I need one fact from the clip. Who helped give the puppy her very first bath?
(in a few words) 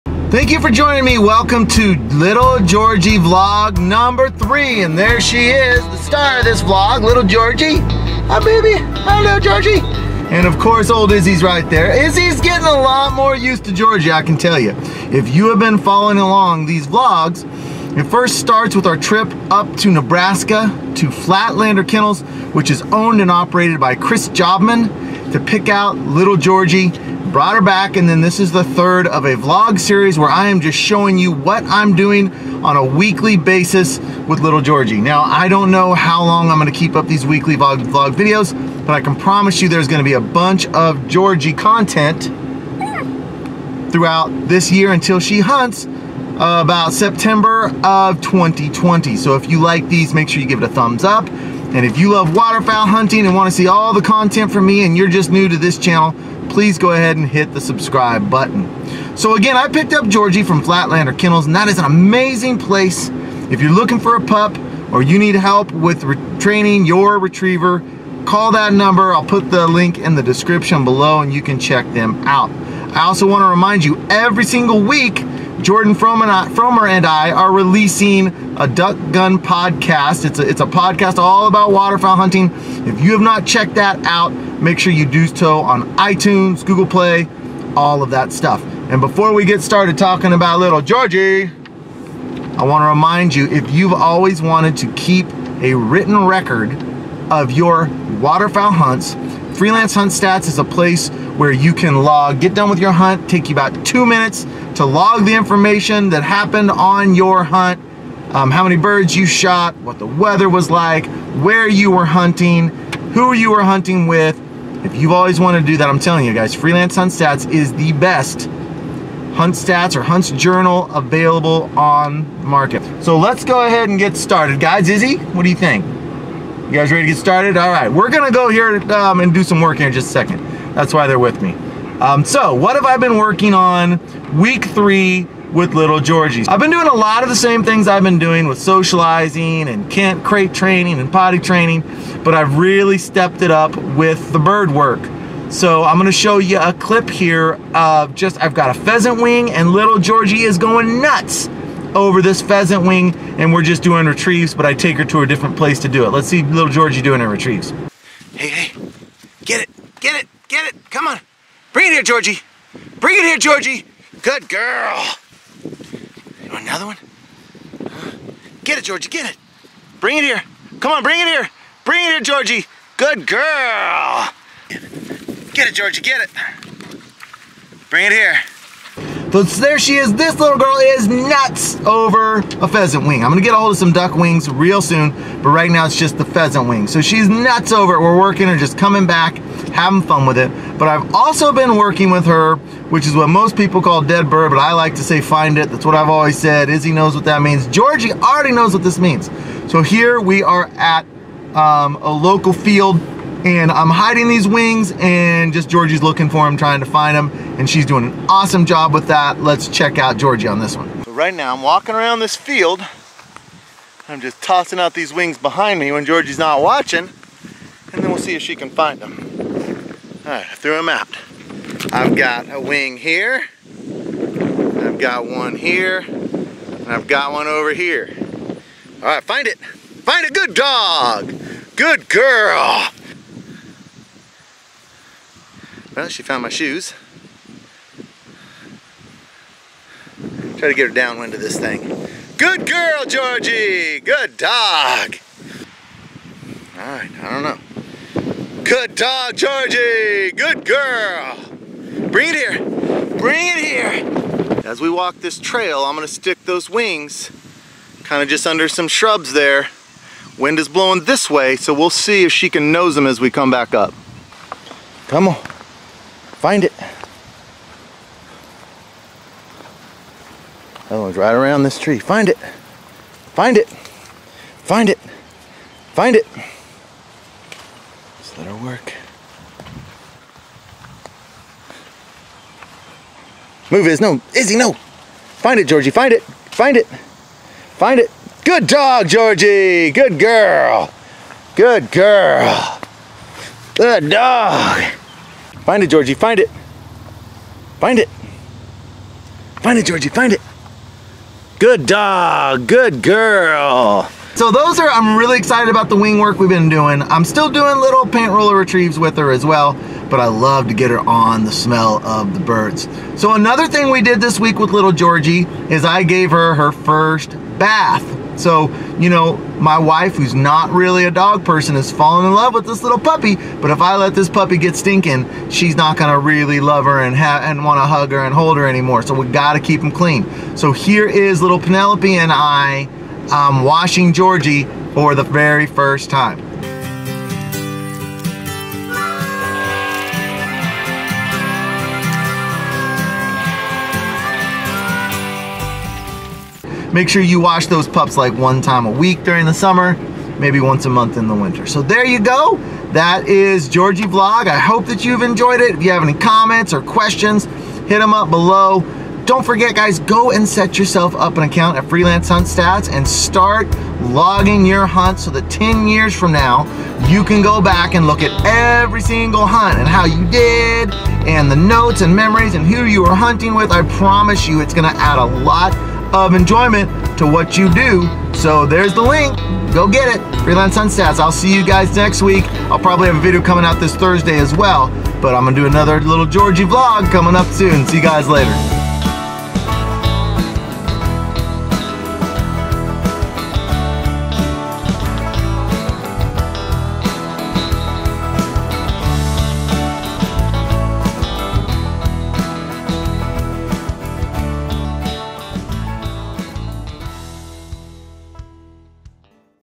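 Penelope.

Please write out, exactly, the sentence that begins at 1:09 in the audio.
I'll put the link in the description below and you can check them out.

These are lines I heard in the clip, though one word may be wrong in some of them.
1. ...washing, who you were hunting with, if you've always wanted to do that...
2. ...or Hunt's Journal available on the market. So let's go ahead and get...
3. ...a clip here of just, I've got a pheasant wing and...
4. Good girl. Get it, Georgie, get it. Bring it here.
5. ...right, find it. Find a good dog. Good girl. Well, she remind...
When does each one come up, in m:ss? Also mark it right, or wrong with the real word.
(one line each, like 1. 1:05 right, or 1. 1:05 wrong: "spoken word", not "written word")
1. 1:52 wrong: "hunting", not "washing"
2. 1:59 right
3. 2:26 right
4. 2:52 right
5. 3:49 wrong: "found", not "remind".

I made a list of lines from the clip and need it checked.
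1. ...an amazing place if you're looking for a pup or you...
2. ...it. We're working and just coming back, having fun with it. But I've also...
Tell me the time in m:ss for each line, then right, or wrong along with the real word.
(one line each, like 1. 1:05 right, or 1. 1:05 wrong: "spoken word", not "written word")
1. 1:01 right
2. 3:07 right.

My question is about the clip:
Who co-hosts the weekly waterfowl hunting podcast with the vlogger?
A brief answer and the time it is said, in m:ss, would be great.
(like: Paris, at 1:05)
Jordan Fromer, at 1:15.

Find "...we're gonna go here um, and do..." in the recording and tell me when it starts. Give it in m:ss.
2:07.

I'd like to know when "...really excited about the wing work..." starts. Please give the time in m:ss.
5:05.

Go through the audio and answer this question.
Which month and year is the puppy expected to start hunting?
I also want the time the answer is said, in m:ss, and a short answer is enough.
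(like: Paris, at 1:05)
September 2020, at 0:46.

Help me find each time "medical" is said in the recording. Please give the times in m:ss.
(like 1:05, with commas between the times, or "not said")
not said.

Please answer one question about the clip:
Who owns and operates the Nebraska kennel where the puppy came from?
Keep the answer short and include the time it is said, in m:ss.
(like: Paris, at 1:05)
Chris Jobman, at 0:23.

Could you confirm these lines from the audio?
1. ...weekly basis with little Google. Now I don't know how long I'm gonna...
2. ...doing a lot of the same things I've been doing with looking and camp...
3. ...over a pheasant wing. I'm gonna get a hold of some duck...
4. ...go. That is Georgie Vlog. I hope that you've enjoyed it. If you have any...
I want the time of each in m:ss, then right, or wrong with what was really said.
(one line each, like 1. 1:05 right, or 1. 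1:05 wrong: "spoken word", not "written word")
1. 0:32 wrong: "Georgie", not "Google"
2. 2:16 wrong: "socializing", not "looking"
3. 3:01 right
4. 5:52 right.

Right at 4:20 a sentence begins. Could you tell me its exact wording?
Wind is blowing this way, so we'll see if she can nose them as we come back up.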